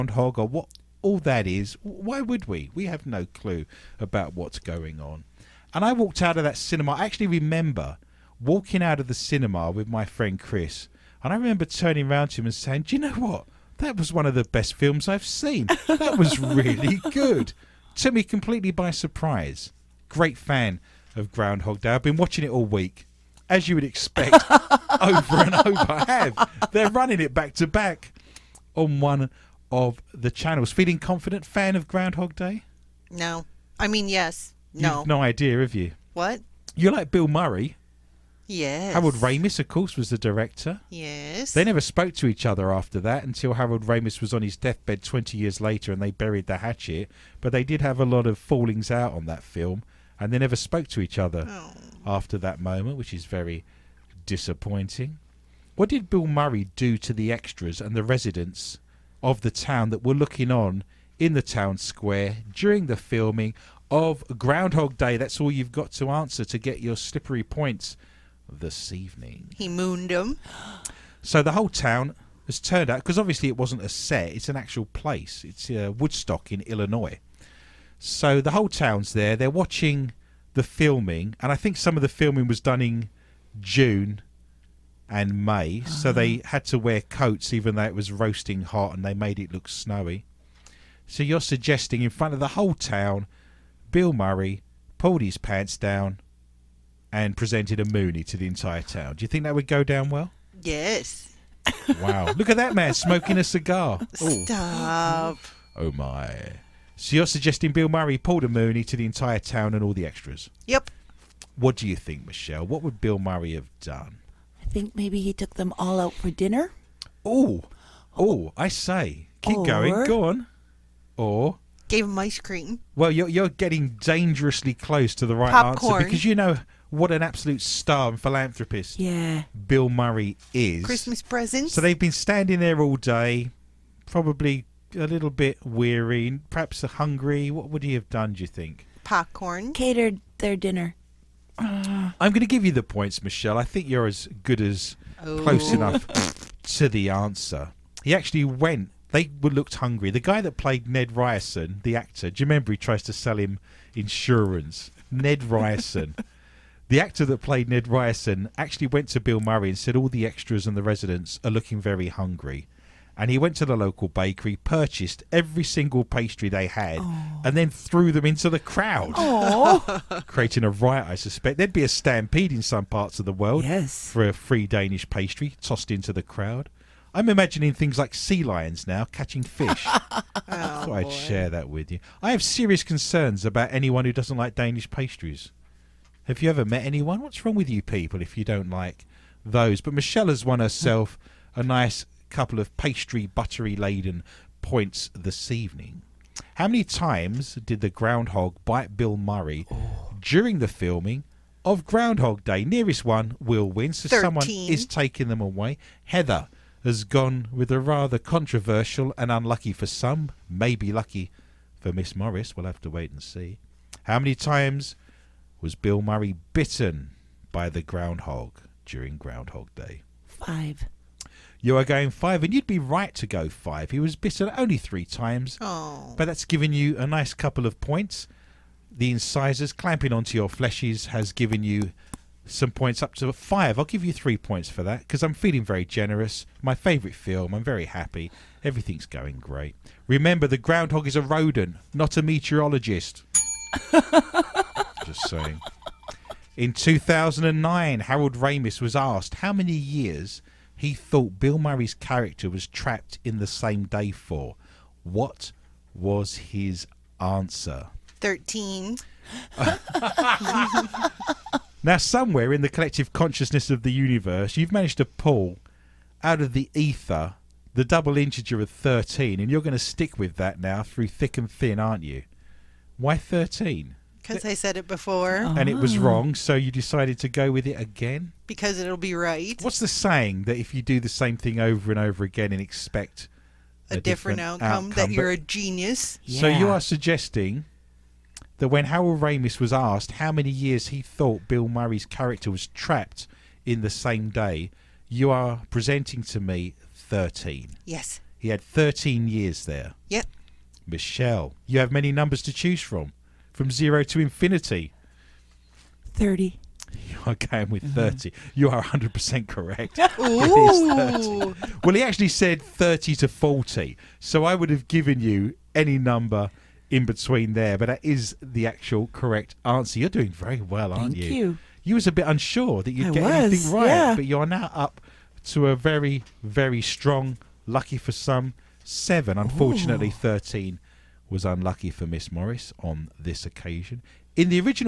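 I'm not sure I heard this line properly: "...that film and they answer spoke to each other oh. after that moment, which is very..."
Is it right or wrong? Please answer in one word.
wrong.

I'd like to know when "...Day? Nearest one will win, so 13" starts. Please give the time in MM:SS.
03:22.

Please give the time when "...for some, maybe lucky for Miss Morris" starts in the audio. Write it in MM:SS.
03:29.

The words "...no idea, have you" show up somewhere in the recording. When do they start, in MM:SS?
00:35.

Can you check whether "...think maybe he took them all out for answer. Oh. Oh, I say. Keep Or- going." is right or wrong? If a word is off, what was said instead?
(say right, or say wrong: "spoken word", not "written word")
wrong: "dinner", not "answer".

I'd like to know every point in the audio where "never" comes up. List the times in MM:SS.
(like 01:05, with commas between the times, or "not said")
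00:41, 00:50.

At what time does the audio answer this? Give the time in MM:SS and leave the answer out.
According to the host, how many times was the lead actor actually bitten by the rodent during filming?
03:44.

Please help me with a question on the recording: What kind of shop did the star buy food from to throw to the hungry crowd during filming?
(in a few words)
local bakery.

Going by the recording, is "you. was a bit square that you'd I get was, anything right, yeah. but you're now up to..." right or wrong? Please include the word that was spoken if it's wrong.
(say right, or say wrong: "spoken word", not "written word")
wrong: "unsure", not "square".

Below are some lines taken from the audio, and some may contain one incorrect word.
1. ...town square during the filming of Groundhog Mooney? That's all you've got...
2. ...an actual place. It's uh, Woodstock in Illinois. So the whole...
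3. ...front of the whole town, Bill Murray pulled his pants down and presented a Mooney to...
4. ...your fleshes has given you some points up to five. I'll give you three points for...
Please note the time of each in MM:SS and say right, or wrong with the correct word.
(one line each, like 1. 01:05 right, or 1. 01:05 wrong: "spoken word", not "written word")
1. 01:01 wrong: "Day", not "Mooney"
2. 01:14 right
3. 01:32 right
4. 03:50 right.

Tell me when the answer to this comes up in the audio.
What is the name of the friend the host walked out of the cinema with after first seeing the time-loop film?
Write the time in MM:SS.
00:09.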